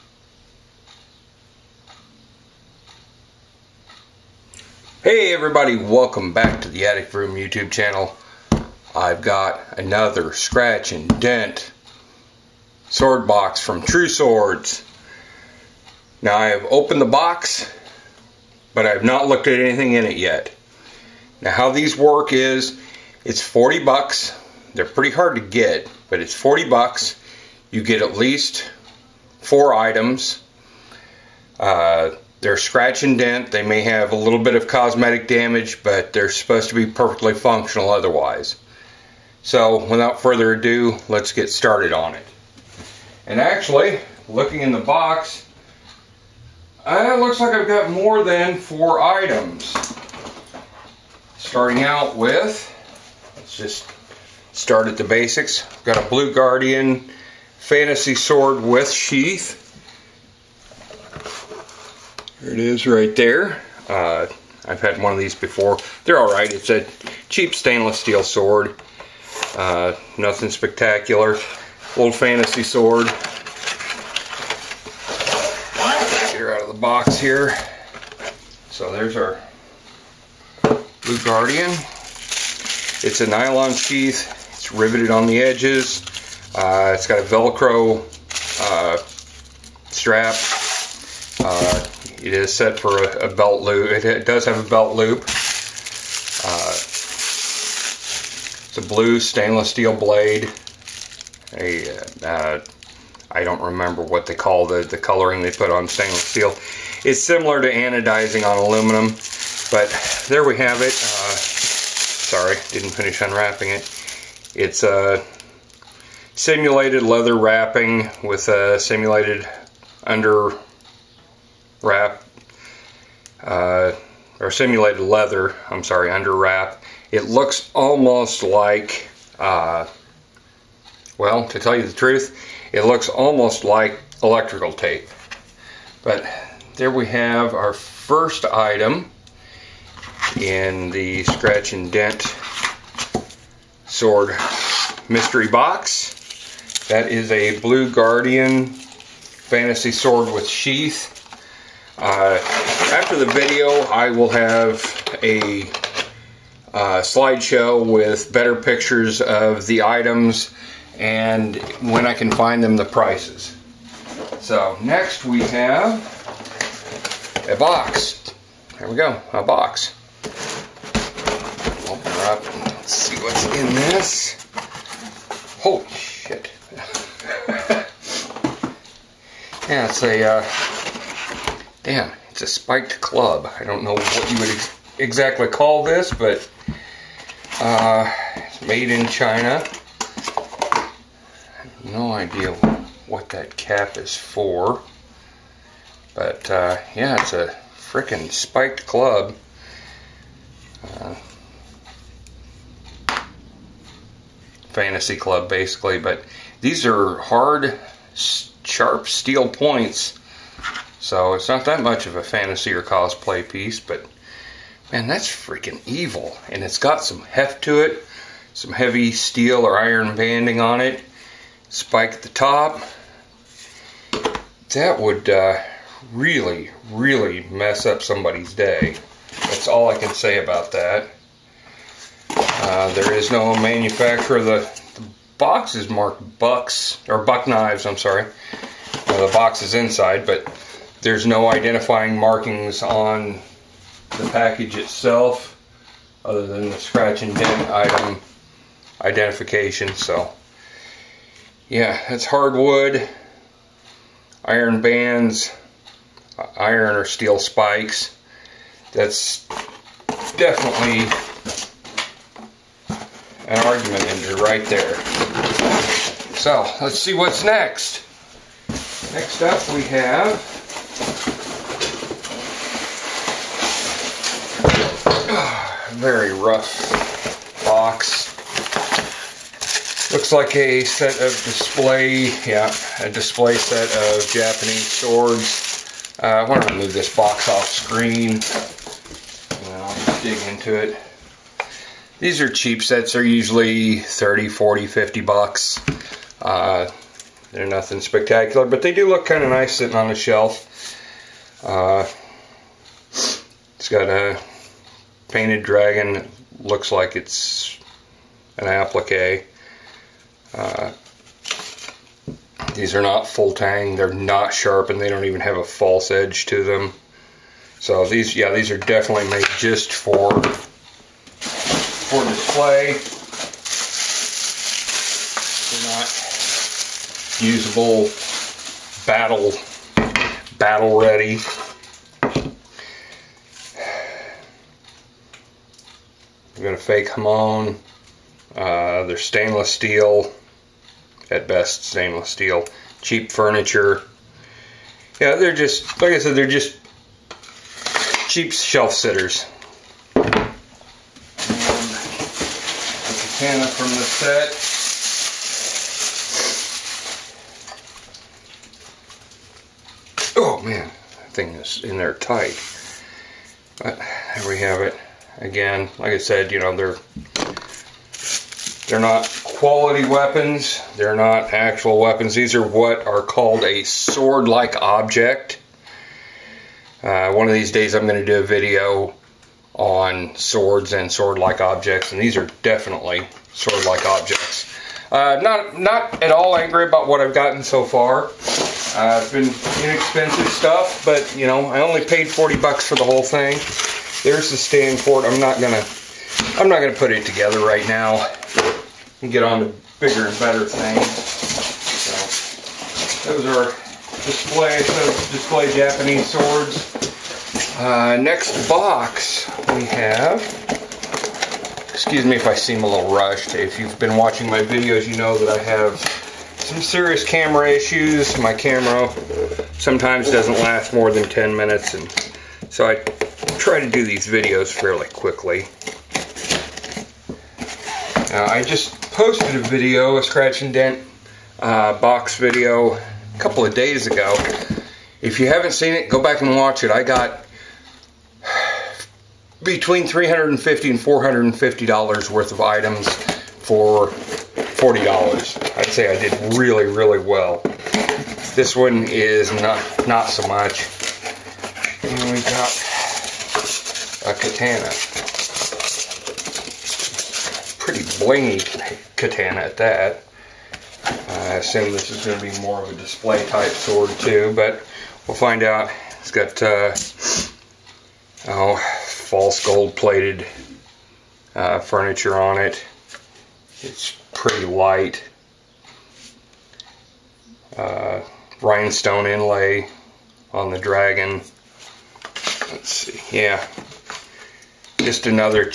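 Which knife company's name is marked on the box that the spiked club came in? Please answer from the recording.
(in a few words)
Buck Knives.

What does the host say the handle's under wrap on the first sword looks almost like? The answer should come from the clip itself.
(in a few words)
electrical tape.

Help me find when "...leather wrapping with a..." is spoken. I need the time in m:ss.
1:57.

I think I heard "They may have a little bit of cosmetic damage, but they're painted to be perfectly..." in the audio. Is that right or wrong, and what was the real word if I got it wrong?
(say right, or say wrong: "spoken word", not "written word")
wrong: "supposed", not "painted".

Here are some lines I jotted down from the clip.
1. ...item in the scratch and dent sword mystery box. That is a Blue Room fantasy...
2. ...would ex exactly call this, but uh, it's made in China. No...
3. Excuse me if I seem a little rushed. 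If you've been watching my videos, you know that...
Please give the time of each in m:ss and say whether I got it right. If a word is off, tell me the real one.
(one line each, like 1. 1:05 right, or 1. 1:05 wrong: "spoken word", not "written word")
1. 2:18 wrong: "Guardian", not "Room"
2. 3:04 right
3. 6:51 right.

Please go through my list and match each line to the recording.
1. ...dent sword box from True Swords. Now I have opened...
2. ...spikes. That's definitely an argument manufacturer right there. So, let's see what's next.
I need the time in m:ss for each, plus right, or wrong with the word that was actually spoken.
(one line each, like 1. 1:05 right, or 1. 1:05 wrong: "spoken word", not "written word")
1. 0:11 right
2. 4:17 wrong: "ender", not "manufacturer".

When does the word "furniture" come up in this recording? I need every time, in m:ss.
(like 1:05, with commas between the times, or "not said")
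5:43, 7:51.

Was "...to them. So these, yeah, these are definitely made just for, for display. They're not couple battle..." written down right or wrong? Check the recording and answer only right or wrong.
wrong.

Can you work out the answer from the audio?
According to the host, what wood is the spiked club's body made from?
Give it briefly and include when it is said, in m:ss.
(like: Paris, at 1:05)
hardwood, at 4:12.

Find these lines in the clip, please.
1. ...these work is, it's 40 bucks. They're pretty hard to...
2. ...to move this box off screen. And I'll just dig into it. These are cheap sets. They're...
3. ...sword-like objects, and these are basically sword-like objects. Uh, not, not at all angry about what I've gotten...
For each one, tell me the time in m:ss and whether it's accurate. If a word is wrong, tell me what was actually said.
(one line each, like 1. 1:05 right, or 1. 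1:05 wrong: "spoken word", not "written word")
1. 0:21 right
2. 4:46 right
3. 6:21 wrong: "definitely", not "basically".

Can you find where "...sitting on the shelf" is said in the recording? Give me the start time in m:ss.
4:59.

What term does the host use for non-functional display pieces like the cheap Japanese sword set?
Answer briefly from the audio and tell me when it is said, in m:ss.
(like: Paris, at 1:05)
sword-like object, at 6:13.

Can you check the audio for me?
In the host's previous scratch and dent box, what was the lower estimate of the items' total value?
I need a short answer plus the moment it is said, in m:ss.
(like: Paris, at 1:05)
$350, at 7:20.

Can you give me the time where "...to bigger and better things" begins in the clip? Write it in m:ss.
6:39.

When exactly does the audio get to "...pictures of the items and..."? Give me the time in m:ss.
2:38.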